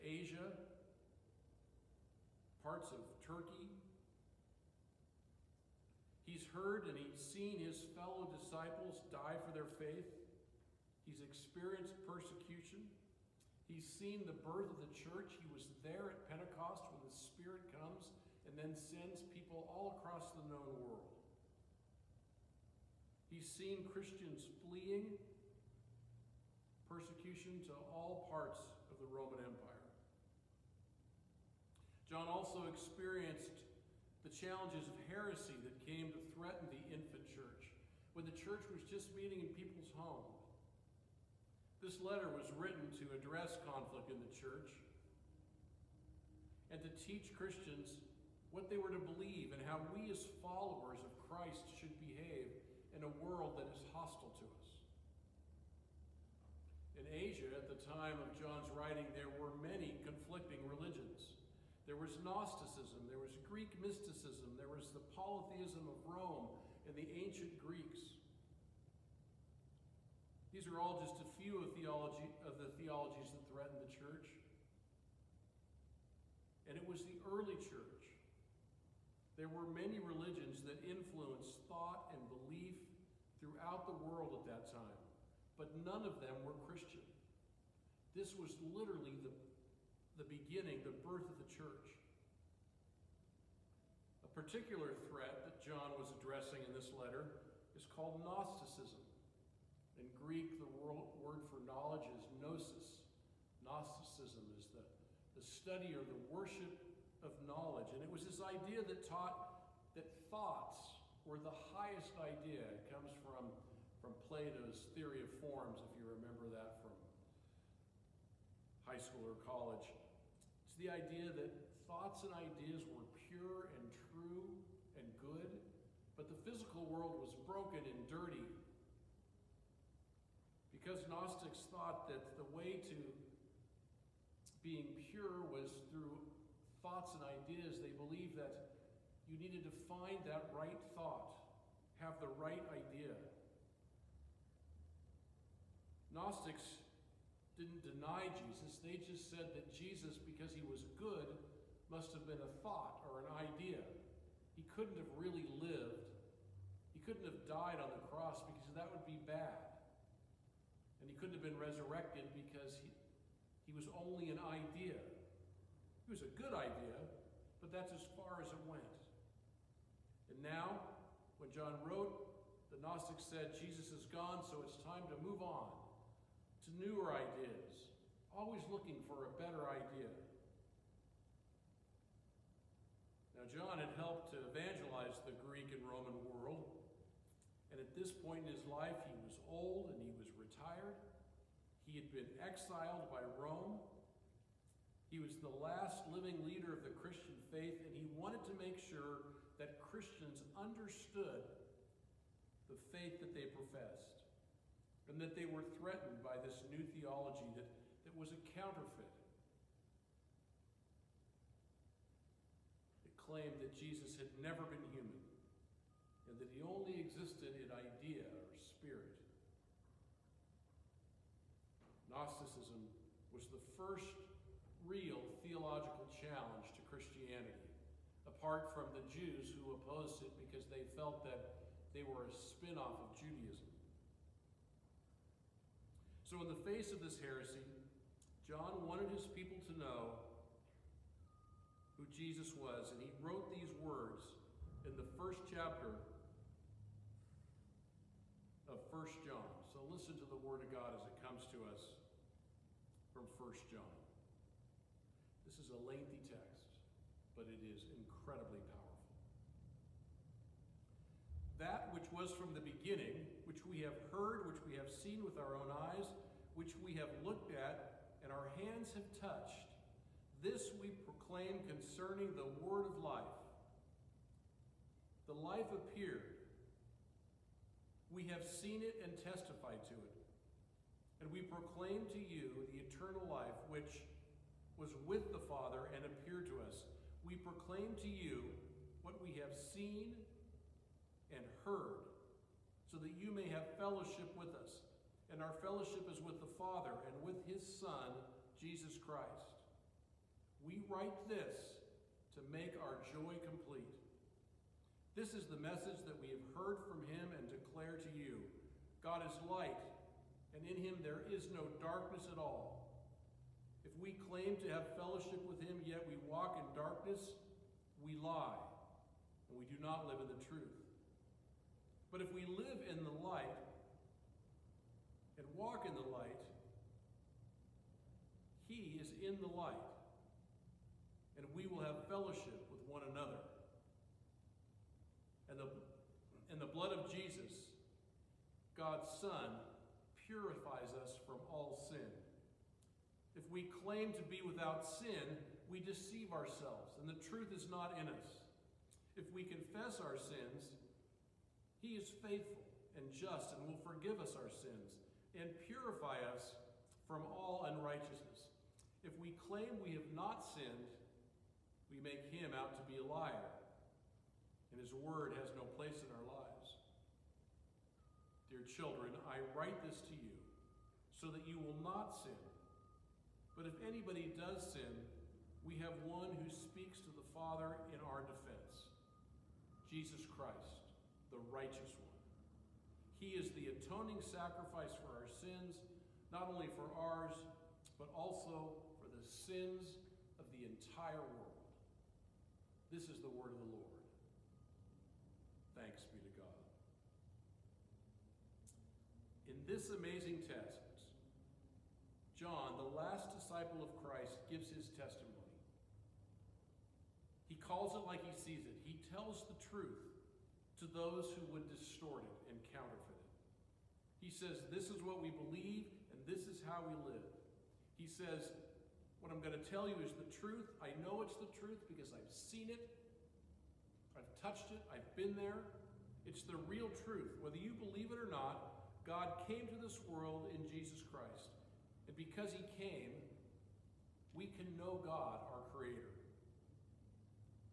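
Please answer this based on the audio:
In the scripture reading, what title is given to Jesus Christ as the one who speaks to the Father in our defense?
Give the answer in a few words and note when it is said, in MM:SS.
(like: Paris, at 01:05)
the righteous one, at 06:21.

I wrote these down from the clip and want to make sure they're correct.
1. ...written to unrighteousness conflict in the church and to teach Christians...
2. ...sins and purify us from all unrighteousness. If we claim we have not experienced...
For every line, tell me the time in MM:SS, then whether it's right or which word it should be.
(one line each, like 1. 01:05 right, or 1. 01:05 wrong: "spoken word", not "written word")
1. 00:42 wrong: "address", not "unrighteousness"
2. 05:54 wrong: "sinned", not "experienced".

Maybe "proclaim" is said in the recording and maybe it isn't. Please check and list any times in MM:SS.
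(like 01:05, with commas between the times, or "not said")
04:30, 04:41, 04:47.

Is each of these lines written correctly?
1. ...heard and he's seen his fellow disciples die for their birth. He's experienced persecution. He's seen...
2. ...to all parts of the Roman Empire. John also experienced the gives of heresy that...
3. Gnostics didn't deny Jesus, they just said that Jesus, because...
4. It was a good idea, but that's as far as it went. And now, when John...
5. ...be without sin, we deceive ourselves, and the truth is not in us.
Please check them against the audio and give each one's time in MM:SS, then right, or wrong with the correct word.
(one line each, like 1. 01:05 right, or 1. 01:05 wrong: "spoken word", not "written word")
1. 00:06 wrong: "faith", not "birth"
2. 00:27 wrong: "challenges", not "gives"
3. 02:26 right
4. 02:46 right
5. 05:44 right.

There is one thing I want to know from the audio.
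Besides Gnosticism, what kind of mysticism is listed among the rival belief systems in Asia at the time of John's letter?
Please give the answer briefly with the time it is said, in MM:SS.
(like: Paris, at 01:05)
Greek mysticism, at 01:03.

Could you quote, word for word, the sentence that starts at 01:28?
This was literally the, the beginning, the birth of the church.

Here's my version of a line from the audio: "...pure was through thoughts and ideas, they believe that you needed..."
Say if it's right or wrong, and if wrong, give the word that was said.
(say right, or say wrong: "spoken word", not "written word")
right.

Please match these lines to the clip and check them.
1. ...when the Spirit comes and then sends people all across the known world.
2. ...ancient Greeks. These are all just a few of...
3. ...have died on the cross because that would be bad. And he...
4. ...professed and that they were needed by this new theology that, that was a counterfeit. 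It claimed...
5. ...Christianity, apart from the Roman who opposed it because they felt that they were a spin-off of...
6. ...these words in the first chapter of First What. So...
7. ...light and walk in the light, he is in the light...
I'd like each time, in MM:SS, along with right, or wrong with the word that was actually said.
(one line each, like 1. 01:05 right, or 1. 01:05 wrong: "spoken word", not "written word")
1. 00:16 right
2. 01:07 right
3. 02:37 right
4. 03:23 wrong: "threatened", not "needed"
5. 03:46 wrong: "Jews", not "Roman"
6. 04:03 wrong: "John", not "What"
7. 05:23 right.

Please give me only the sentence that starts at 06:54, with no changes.
He says, This is what we believe, and this is how we live.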